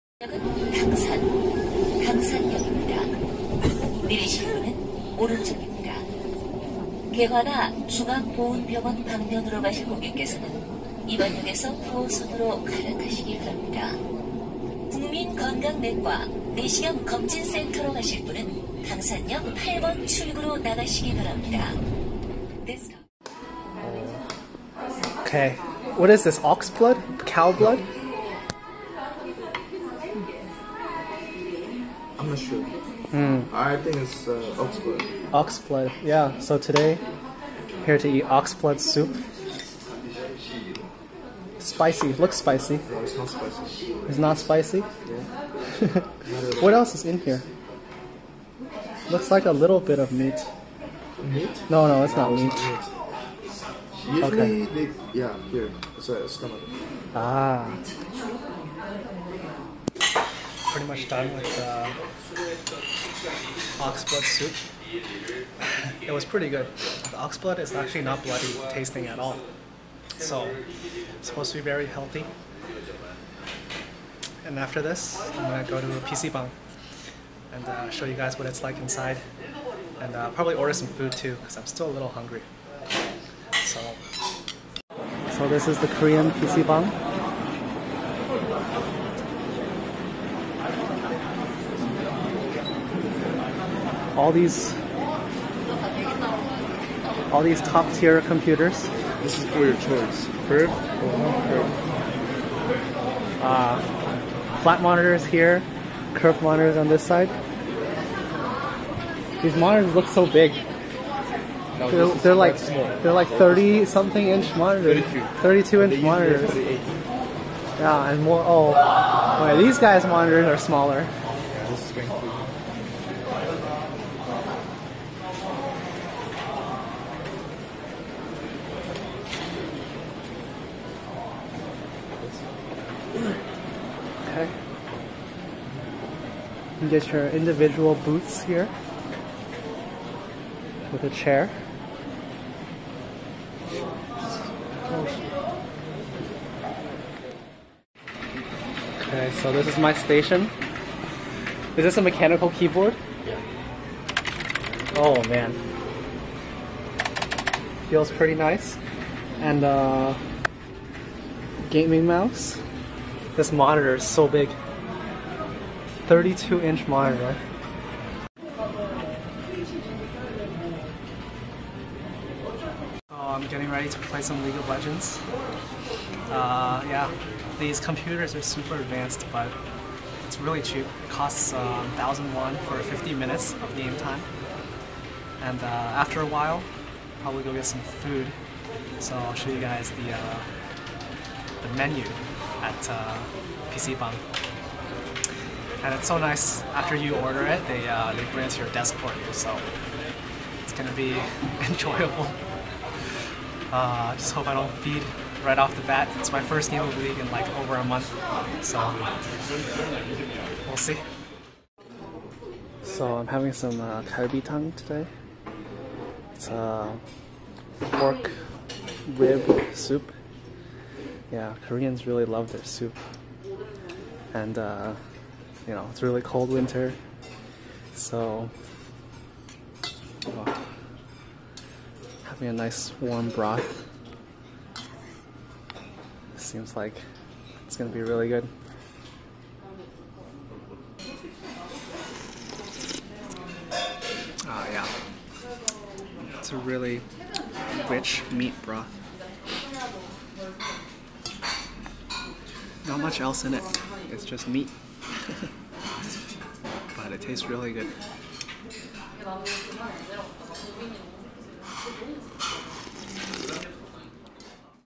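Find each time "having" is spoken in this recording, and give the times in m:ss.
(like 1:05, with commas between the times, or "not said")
3:33, 3:52.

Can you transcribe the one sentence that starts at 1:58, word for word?
Oh, wait, these guys' monitors are smaller.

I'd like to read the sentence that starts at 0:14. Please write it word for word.
국민건강내과 내시경 검진센터로 가실 분은 강산역 8번 출구로 나가시기 바랍니다.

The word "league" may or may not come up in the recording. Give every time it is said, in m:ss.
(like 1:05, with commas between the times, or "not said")
2:54, 3:27.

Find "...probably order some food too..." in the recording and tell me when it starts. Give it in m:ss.
1:20.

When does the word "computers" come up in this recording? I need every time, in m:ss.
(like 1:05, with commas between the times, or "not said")
1:38, 2:57.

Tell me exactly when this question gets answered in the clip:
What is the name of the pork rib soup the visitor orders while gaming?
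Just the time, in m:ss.
3:34.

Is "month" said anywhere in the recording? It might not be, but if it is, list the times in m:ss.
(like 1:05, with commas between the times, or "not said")
3:27.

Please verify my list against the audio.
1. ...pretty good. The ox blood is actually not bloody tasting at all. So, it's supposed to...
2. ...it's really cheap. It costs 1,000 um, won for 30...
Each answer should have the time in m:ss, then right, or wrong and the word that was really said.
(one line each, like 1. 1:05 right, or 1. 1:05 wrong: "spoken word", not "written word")
1. 1:06 right
2. 3:00 wrong: "50", not "30".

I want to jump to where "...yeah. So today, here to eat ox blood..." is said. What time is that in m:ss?
0:36.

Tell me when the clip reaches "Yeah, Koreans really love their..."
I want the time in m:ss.
3:41.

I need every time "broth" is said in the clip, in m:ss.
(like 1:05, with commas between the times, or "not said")
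3:53, 4:08.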